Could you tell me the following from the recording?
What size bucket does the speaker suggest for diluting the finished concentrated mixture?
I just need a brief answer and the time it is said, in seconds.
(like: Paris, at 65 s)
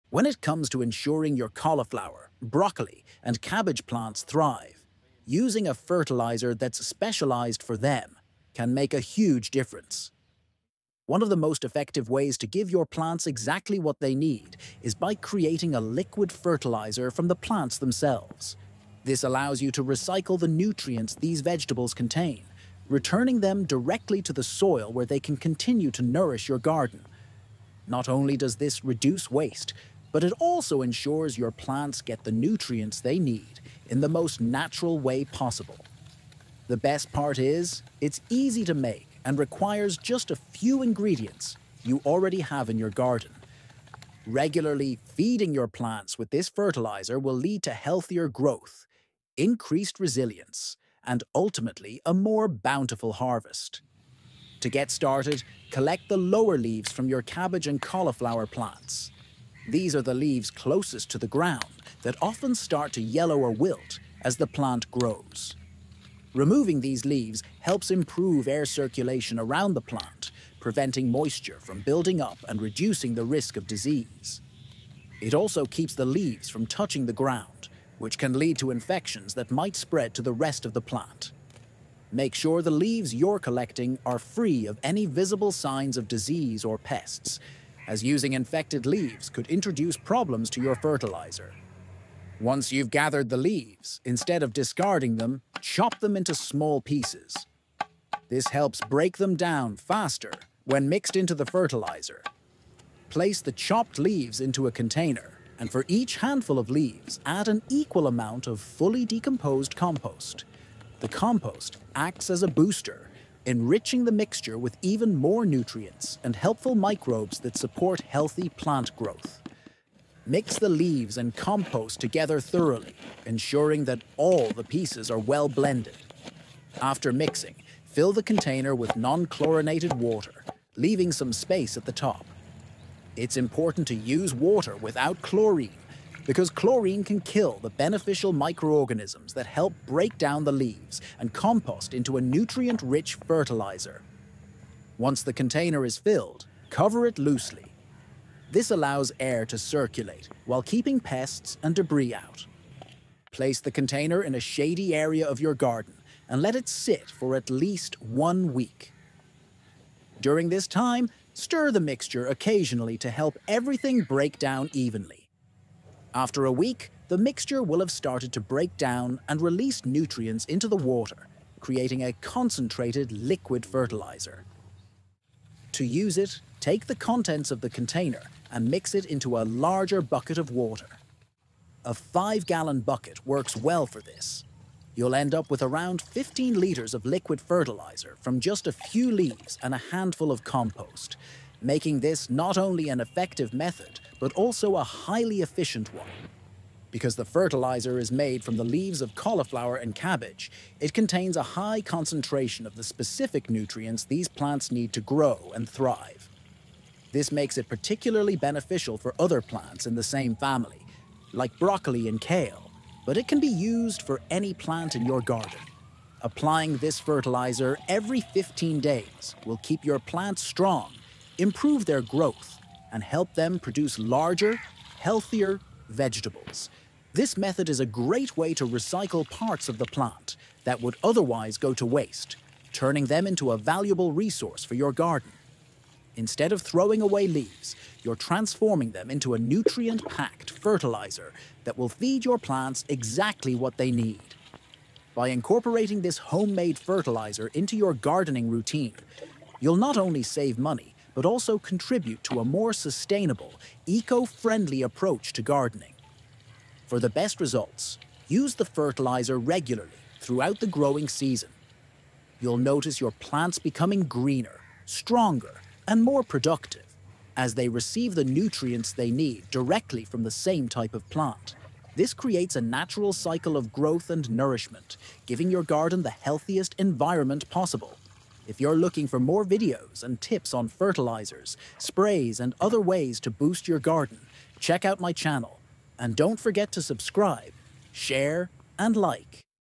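5 gallon, at 181 s.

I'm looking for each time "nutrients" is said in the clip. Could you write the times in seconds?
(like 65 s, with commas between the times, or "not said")
20 s, 32 s, 115 s, 142 s, 169 s, 203 s, 239 s, 268 s.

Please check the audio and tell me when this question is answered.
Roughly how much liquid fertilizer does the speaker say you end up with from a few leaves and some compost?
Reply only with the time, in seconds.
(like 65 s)
186 s.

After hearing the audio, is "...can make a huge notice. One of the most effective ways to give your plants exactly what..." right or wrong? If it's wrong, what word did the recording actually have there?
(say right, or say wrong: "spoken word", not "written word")
wrong: "difference", not "notice".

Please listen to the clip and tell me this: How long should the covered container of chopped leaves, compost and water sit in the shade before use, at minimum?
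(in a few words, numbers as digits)
1 week.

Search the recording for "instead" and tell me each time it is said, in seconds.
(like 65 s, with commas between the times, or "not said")
94 s, 236 s.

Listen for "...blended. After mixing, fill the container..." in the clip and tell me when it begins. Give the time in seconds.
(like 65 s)
125 s.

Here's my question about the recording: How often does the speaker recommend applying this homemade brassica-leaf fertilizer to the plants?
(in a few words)
every 15 days.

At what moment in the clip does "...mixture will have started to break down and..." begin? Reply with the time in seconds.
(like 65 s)
167 s.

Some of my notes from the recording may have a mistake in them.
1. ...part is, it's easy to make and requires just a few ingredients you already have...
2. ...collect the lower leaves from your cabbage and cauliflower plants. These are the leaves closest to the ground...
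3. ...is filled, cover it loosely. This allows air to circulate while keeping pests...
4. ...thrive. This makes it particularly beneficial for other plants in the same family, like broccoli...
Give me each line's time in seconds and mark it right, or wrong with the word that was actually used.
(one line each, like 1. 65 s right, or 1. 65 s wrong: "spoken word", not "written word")
1. 37 s right
2. 55 s right
3. 145 s right
4. 205 s right.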